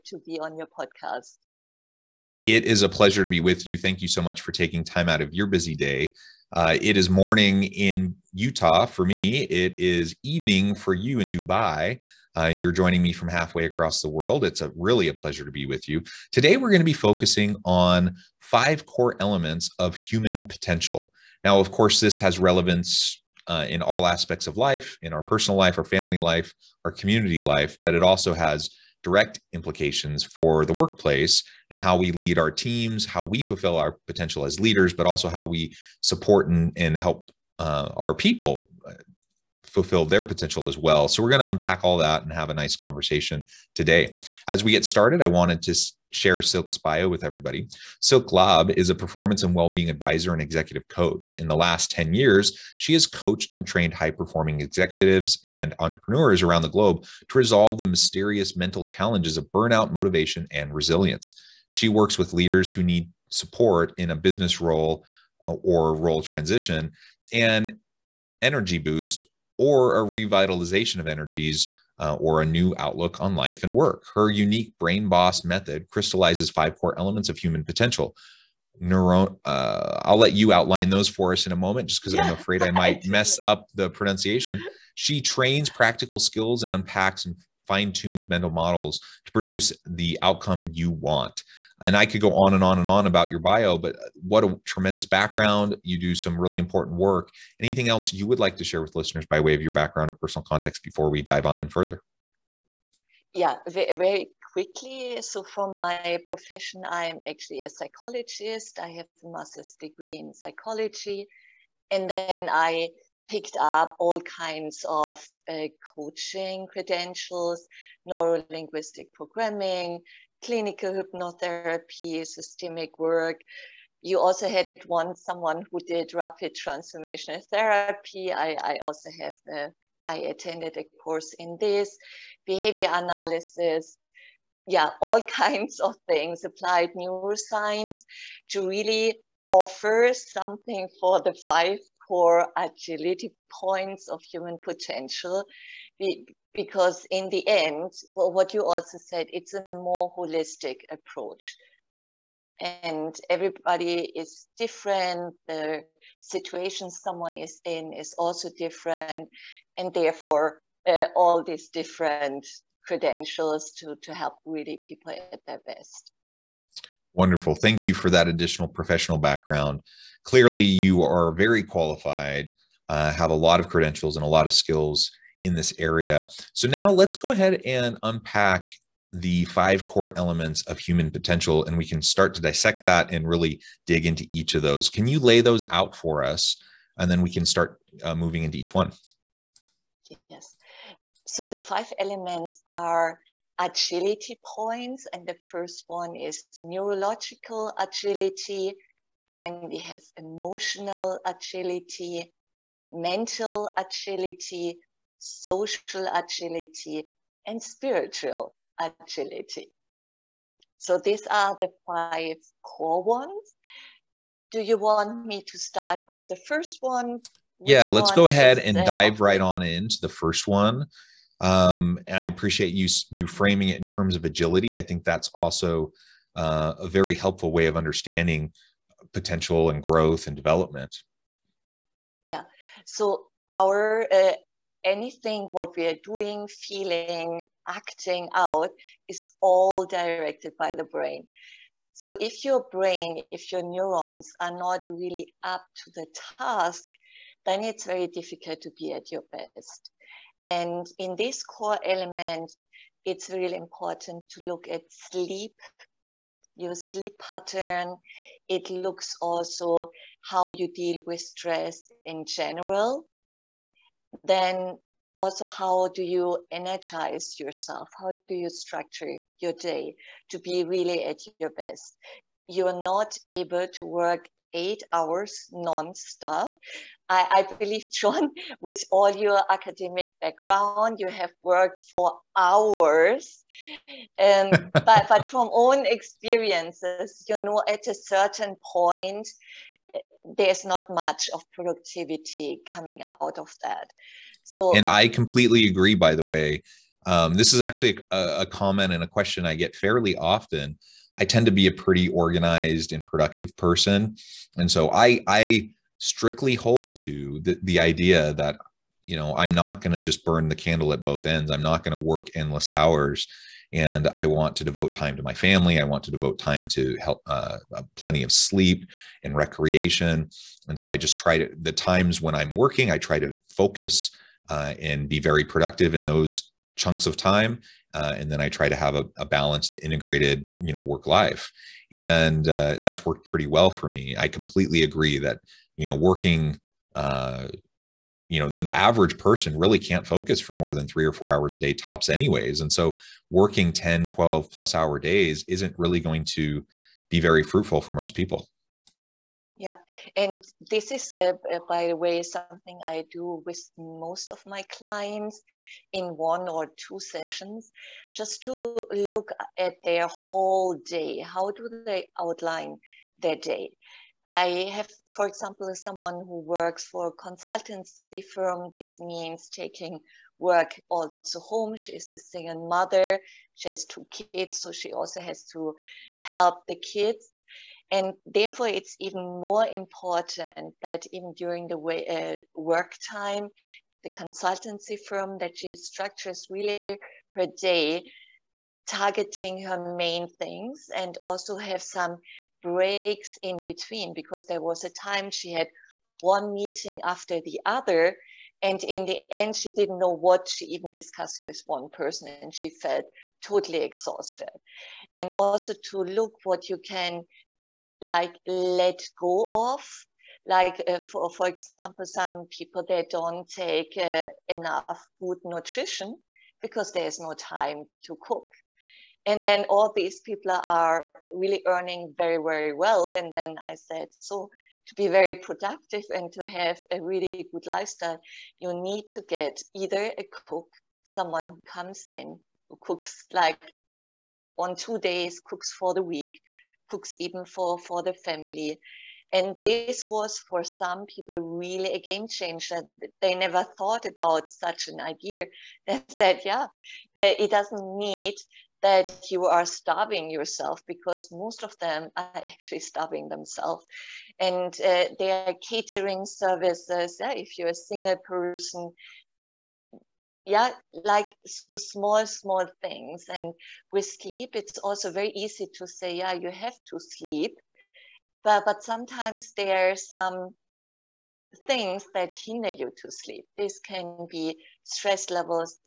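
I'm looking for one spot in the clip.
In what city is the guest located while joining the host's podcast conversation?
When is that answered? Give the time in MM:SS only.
00:11.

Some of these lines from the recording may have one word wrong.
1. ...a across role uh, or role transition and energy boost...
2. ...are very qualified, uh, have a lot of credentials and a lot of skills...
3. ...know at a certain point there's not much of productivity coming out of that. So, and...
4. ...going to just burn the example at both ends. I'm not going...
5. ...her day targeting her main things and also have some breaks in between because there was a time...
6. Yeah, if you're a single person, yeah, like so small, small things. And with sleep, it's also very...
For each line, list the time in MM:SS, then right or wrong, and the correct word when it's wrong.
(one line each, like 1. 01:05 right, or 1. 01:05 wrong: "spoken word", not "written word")
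1. 01:04 wrong: "business", not "across"
2. 02:51 right
3. 04:47 right
4. 05:09 wrong: "candle", not "example"
5. 06:27 right
6. 07:37 right.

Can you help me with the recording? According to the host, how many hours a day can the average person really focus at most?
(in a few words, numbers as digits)
3 or 4 hours.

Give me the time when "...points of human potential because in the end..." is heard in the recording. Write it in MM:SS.
02:23.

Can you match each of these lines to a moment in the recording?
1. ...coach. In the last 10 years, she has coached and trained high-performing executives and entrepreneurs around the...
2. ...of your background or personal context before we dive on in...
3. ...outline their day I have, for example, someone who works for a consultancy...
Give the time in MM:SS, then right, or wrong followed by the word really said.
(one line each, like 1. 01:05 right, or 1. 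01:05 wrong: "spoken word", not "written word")
1. 00:50 right
2. 01:39 right
3. 06:02 right.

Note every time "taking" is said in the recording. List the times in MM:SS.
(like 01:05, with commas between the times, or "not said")
00:04, 06:09.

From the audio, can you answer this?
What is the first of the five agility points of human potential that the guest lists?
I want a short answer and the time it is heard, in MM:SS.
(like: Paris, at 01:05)
neurological agility, at 03:16.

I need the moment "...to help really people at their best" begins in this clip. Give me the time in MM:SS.
02:44.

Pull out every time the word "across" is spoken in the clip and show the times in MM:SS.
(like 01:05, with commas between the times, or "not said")
00:13.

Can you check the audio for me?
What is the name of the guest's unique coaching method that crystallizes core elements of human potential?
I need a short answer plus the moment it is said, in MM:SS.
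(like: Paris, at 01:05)
BrainBoss, at 01:14.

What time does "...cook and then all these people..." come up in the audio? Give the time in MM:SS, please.
06:58.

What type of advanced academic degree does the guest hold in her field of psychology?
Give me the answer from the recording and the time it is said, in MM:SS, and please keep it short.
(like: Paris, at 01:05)
master's degree, at 01:49.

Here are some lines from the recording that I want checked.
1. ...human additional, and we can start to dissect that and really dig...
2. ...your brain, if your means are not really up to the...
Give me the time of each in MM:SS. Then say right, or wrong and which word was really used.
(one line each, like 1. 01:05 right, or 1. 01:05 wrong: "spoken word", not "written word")
1. 03:00 wrong: "potential", not "additional"
2. 04:02 wrong: "neurons", not "means".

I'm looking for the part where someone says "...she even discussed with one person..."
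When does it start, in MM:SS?
06:40.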